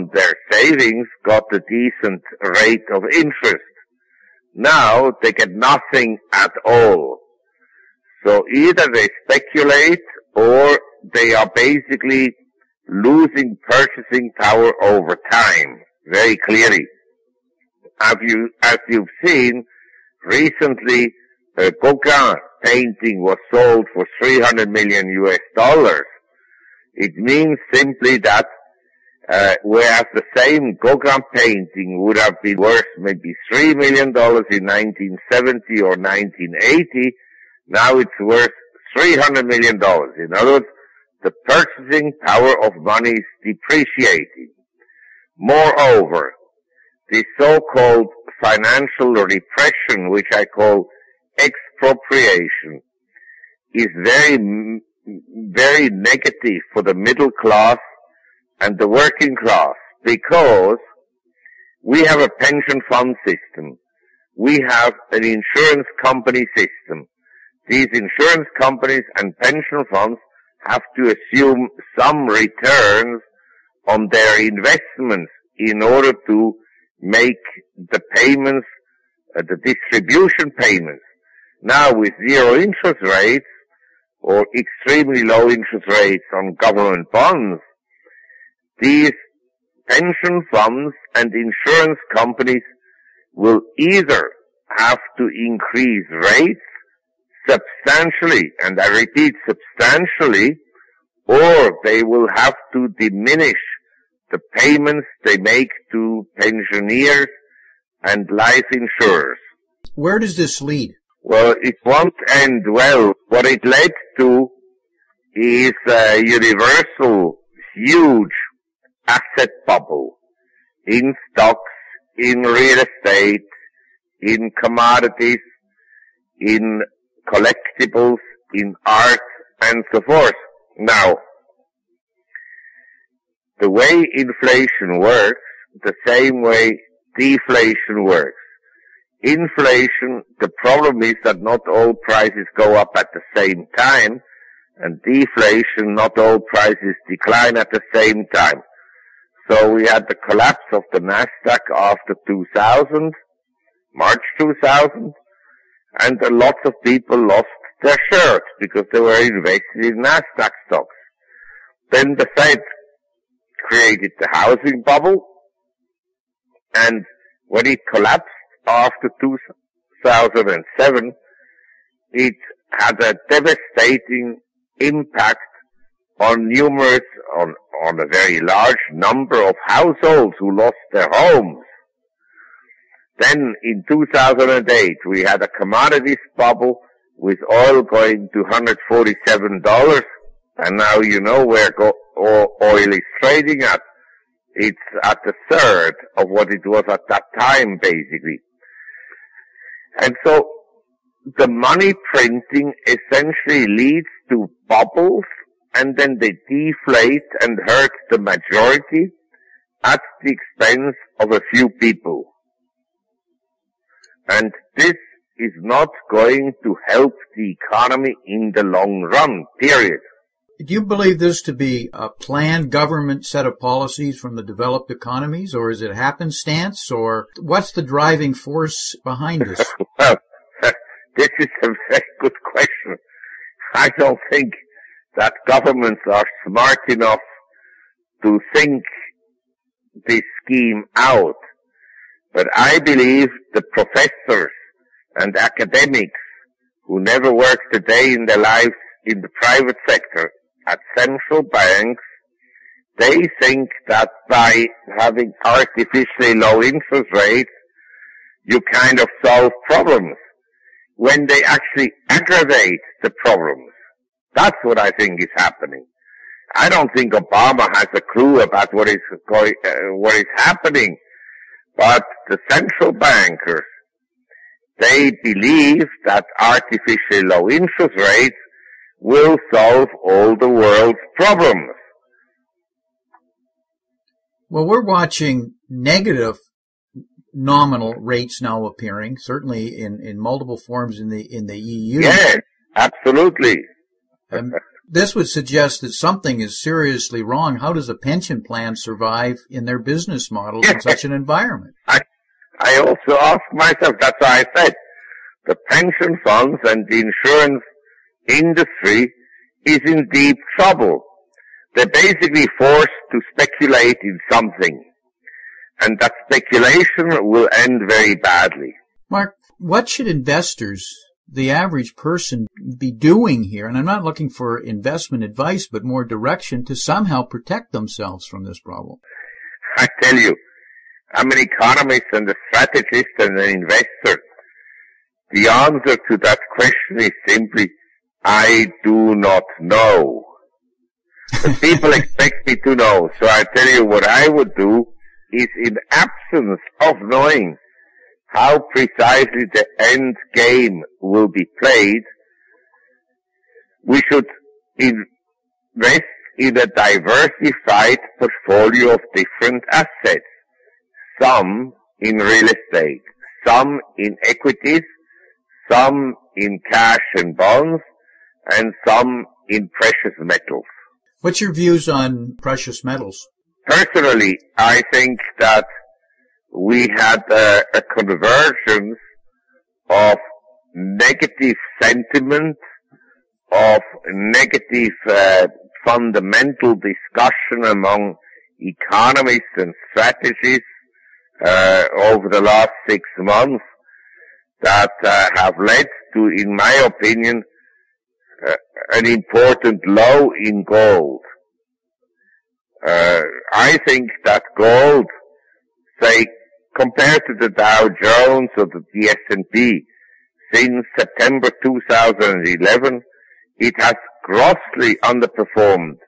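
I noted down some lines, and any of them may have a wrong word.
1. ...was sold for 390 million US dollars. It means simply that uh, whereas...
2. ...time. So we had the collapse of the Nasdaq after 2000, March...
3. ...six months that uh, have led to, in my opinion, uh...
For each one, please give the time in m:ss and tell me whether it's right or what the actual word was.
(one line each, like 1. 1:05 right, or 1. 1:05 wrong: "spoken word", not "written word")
1. 0:23 wrong: "300", not "390"
2. 2:28 right
3. 6:32 right.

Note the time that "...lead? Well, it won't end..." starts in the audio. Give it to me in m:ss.
1:50.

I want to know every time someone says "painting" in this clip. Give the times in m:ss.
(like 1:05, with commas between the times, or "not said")
0:22, 0:31.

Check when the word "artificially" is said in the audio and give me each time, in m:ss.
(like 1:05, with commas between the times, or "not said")
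4:15, 4:36.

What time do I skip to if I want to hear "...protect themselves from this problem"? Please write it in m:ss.
5:27.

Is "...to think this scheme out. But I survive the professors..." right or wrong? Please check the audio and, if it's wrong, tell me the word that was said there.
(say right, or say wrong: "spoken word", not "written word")
wrong: "believe", not "survive".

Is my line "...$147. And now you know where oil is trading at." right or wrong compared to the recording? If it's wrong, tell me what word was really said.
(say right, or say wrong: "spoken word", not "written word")
right.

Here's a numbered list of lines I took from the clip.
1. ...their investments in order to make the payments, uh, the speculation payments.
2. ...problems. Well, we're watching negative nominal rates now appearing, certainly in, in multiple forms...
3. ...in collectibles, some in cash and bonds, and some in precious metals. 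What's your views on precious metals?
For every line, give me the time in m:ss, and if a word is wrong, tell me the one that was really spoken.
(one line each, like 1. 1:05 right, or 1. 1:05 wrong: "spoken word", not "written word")
1. 1:14 wrong: "distribution", not "speculation"
2. 4:41 right
3. 6:03 wrong: "equities", not "collectibles".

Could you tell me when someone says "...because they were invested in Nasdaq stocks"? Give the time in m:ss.
2:38.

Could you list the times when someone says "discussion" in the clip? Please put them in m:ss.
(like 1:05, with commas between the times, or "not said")
6:26.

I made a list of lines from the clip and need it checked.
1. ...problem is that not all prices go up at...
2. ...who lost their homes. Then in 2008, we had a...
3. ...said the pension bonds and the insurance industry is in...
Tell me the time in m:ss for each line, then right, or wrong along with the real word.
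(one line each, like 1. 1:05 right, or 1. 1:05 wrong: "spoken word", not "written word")
1. 2:20 right
2. 3:00 right
3. 5:04 wrong: "funds", not "bonds".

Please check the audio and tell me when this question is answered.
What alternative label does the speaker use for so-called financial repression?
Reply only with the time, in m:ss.
0:51.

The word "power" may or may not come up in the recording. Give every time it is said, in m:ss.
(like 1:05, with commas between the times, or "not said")
0:14, 0:42.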